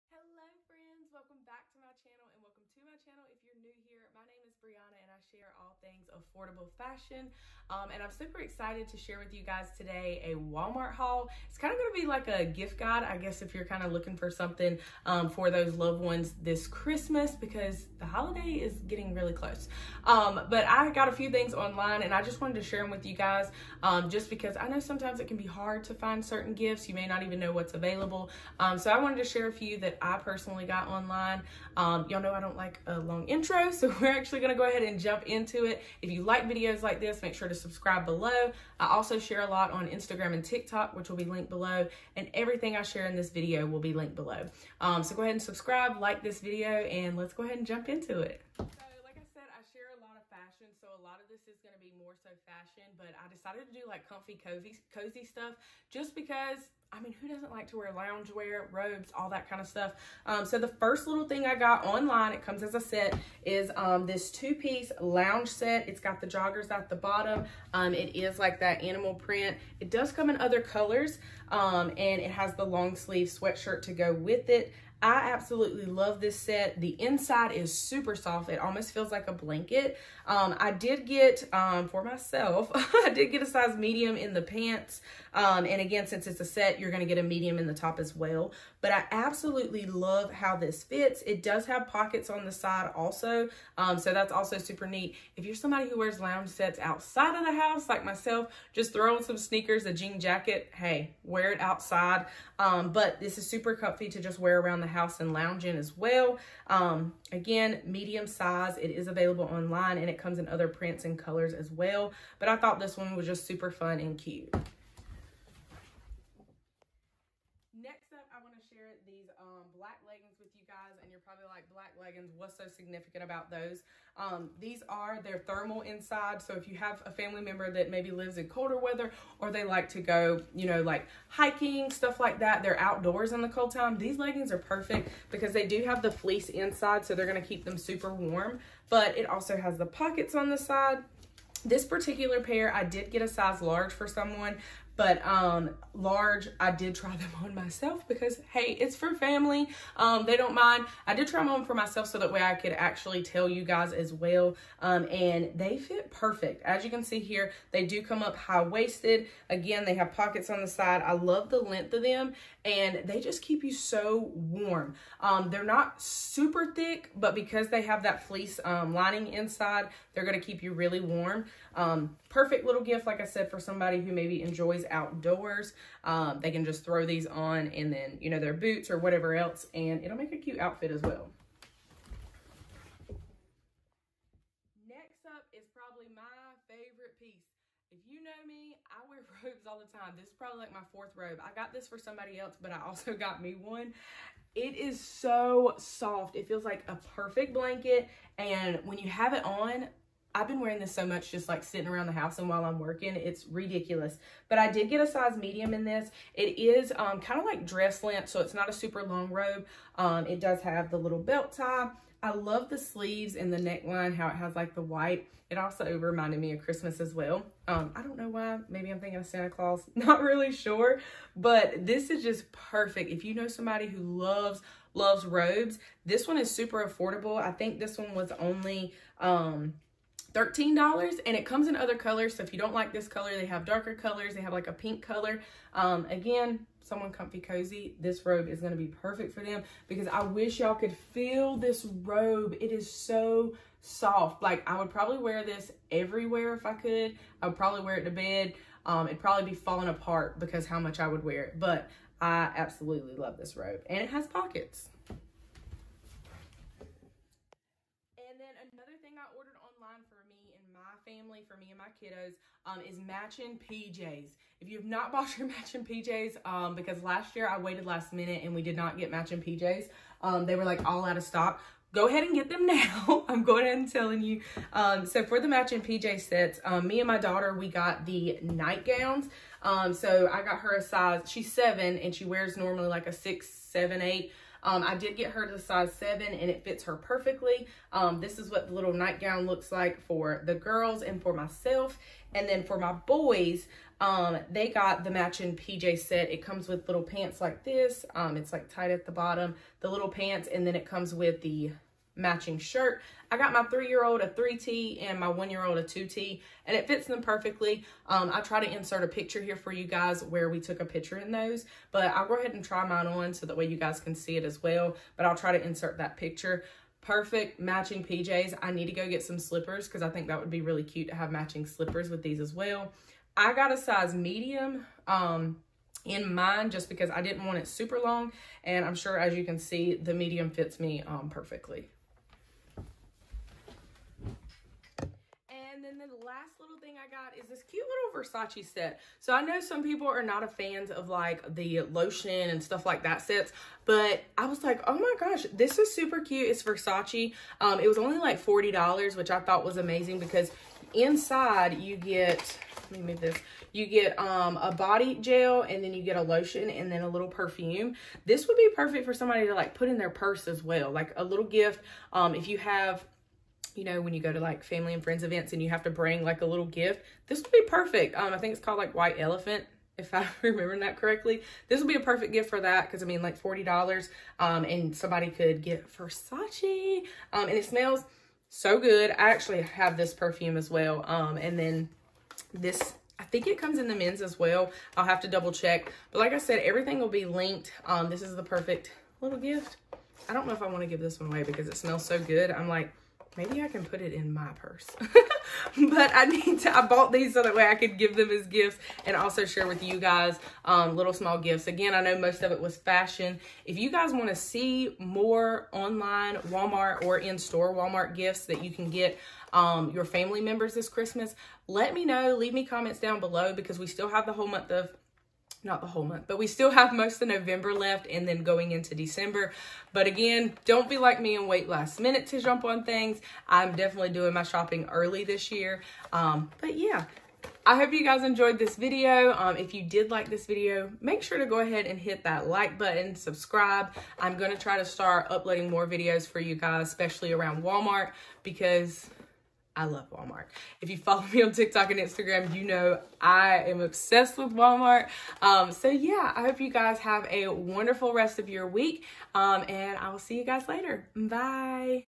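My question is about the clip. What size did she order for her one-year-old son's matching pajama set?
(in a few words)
2T.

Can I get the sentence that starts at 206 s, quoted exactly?
It is um, kind of like dress length, so it's not a super long robe.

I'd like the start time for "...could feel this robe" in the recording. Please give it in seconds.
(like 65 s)
240 s.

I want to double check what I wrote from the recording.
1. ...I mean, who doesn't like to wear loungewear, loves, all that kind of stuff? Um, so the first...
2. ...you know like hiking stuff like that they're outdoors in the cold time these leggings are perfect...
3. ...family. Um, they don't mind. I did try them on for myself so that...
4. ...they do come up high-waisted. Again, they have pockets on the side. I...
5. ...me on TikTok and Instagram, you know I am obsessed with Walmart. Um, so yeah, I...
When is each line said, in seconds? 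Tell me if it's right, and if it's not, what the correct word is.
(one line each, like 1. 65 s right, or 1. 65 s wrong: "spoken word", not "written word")
1. 56 s wrong: "robes", not "loves"
2. 130 s right
3. 149 s right
4. 157 s right
5. 441 s right.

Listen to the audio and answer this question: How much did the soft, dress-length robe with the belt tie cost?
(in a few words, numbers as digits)
$13.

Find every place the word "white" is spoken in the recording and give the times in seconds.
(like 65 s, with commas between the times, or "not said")
214 s, 368 s.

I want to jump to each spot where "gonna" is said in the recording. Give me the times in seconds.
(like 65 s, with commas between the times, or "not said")
34 s.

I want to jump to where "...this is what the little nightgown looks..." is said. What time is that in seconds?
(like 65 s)
288 s.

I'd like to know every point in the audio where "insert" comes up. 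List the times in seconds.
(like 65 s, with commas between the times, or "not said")
308 s, 315 s.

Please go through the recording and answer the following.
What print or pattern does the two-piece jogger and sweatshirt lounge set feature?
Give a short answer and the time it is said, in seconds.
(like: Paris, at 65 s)
Animal print, at 68 s.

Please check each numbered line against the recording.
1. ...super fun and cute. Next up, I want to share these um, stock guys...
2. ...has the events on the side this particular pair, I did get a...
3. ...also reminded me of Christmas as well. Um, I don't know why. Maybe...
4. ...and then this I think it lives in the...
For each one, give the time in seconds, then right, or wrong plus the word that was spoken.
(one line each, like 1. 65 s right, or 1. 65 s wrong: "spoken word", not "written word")
1. 113 s wrong: "black", not "stock"
2. 139 s wrong: "pockets", not "events"
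3. 215 s right
4. 381 s wrong: "comes", not "lives".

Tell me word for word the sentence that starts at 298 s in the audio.
Um, it's like tied at the bottom, the little pants, and then it comes with the matching shirt.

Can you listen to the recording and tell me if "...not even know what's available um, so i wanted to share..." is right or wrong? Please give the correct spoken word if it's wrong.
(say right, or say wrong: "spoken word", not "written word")
right.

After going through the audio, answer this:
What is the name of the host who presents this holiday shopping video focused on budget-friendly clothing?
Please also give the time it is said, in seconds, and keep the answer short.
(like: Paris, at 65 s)
Breanna, at 4 s.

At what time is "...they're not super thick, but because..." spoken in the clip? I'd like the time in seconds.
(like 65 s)
165 s.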